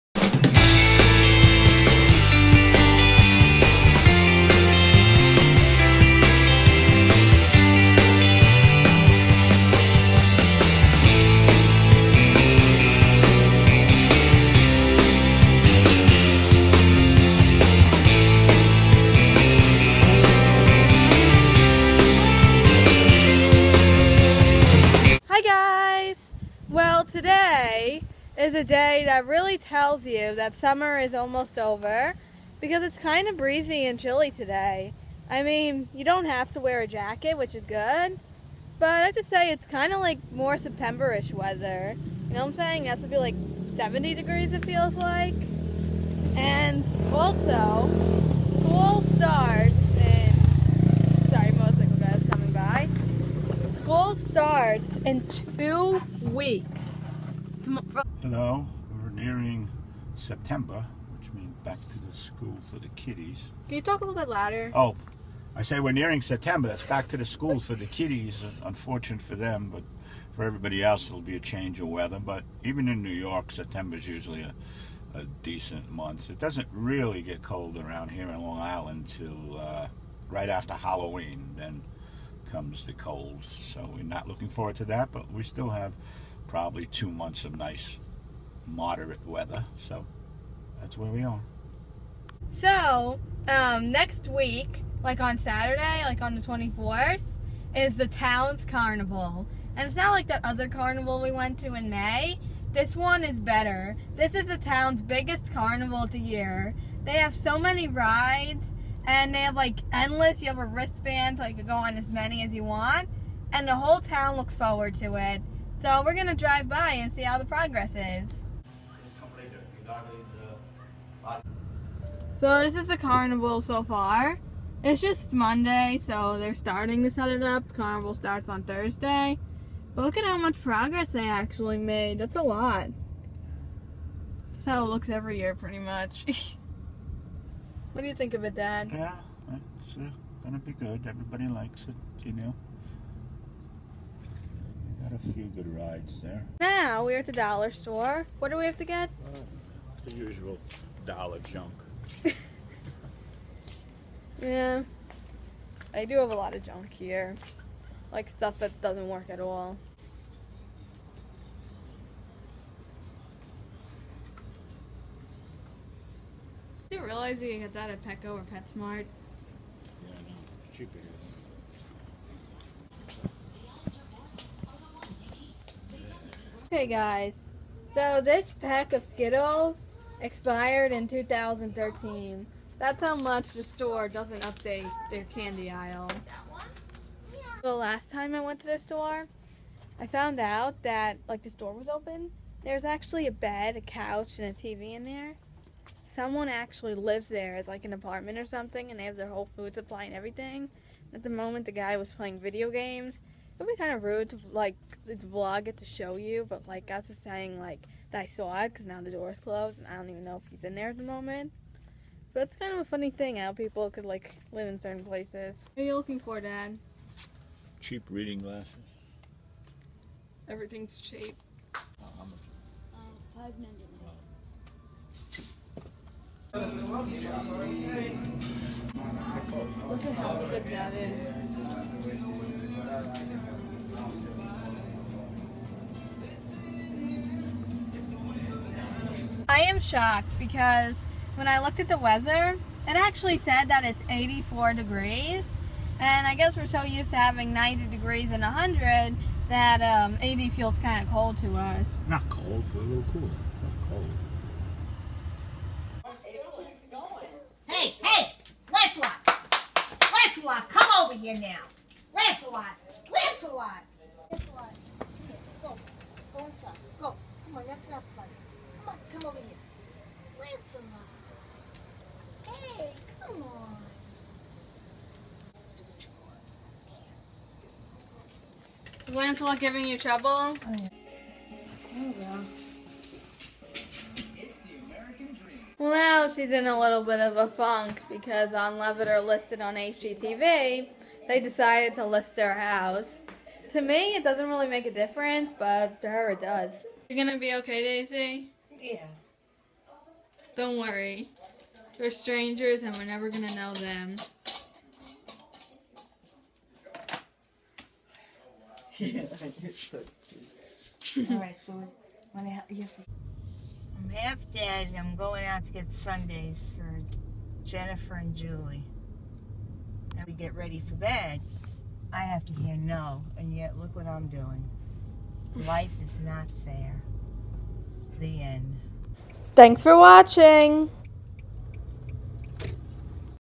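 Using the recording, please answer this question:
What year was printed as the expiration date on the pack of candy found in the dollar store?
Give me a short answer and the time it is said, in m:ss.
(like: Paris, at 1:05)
2013, at 3:01.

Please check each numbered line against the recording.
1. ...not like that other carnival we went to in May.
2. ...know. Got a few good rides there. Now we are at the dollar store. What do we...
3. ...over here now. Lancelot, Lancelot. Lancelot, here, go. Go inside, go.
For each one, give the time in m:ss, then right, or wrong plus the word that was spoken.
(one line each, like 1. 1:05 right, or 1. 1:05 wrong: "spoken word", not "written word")
1. 1:39 right
2. 2:22 right
3. 4:21 right.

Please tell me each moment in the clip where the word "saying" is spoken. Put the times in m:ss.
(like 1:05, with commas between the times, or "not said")
0:42, 3:27.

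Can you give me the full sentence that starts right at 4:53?
To me, it doesn't really make a difference, but to her, it does.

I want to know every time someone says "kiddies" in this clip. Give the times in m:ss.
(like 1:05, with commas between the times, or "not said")
1:02, 1:07.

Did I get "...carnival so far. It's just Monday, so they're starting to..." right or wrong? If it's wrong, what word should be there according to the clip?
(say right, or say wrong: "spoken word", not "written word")
right.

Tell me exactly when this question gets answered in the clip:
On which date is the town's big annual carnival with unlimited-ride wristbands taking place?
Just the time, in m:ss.
1:36.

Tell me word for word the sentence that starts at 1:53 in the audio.
And the whole town looks forward to it.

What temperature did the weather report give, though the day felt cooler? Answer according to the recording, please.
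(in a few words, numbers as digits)
84 degrees.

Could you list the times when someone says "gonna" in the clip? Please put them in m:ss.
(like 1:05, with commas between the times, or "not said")
1:56, 2:20, 4:57.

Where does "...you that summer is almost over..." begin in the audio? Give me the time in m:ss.
0:30.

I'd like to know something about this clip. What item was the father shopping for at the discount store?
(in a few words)
Cheap reading glasses.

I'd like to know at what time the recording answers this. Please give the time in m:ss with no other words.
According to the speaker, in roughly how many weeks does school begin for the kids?
0:55.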